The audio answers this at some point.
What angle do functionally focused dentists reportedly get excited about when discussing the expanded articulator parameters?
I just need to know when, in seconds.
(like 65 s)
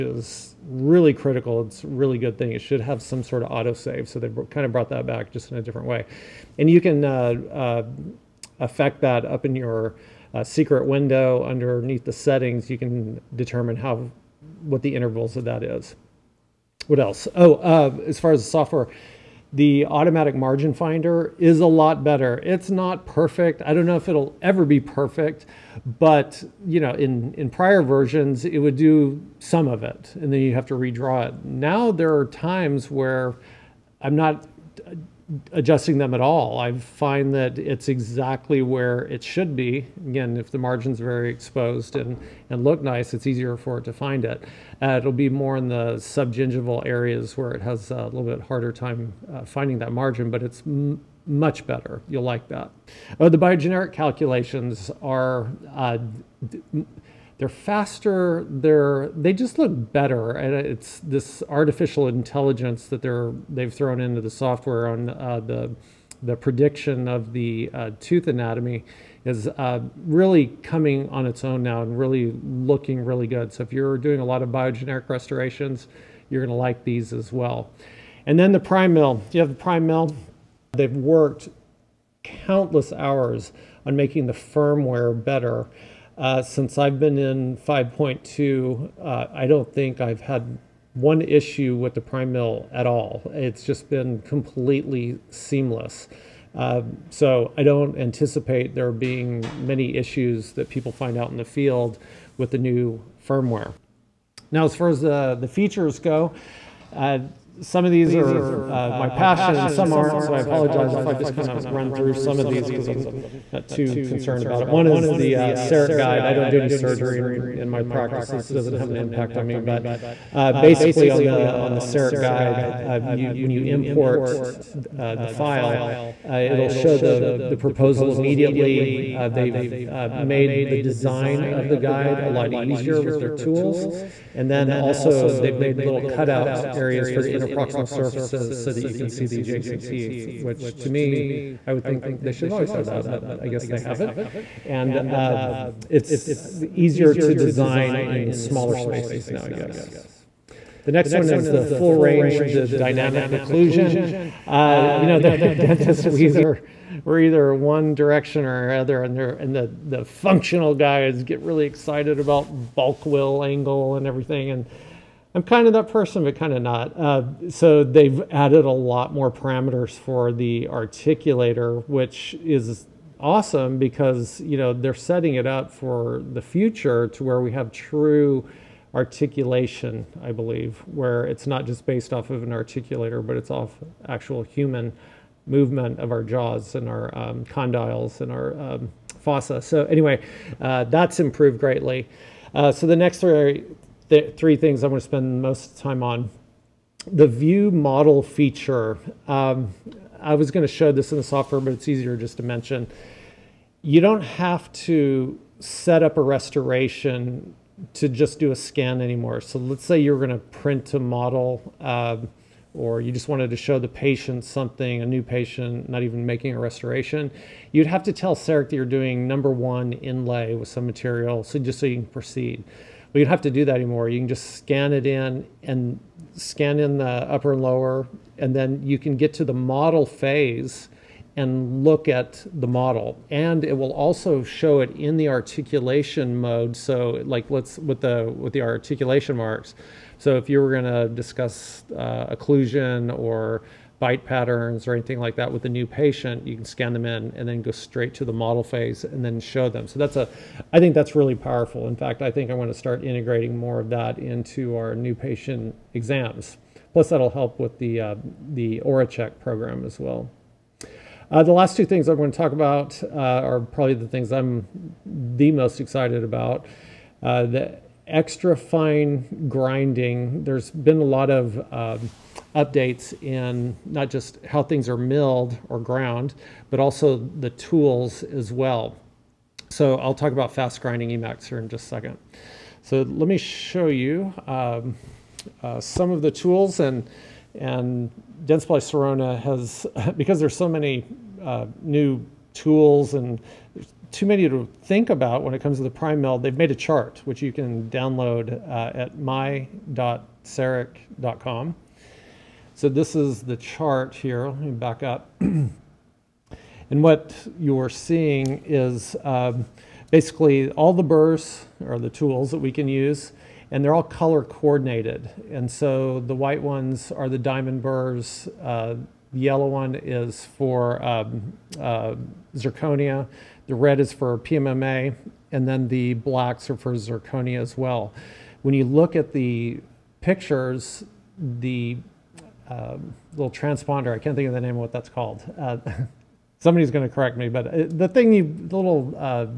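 162 s.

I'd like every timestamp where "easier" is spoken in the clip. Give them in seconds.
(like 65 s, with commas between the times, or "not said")
43 s, 132 s, 146 s, 201 s.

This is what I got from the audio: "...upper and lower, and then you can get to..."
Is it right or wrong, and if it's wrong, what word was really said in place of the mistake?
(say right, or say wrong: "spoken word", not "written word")
right.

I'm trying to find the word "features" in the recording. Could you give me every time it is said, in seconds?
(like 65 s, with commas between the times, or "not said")
105 s, 198 s.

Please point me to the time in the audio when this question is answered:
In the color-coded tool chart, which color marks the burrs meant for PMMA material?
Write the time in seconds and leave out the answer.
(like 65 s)
323 s.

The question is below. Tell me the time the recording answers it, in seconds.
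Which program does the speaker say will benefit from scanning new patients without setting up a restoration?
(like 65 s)
258 s.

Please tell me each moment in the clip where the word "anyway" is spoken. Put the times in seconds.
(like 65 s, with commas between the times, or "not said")
189 s.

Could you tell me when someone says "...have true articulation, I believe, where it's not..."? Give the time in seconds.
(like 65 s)
177 s.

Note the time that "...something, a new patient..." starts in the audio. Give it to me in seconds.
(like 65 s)
214 s.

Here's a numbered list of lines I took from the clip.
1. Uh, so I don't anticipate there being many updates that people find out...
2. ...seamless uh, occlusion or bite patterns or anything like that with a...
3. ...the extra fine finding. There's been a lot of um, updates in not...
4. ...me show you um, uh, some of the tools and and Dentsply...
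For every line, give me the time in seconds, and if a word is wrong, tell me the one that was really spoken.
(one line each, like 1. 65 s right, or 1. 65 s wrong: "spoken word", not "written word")
1. 96 s wrong: "issues", not "updates"
2. 241 s wrong: "discuss", not "seamless"
3. 267 s wrong: "grinding", not "finding"
4. 283 s right.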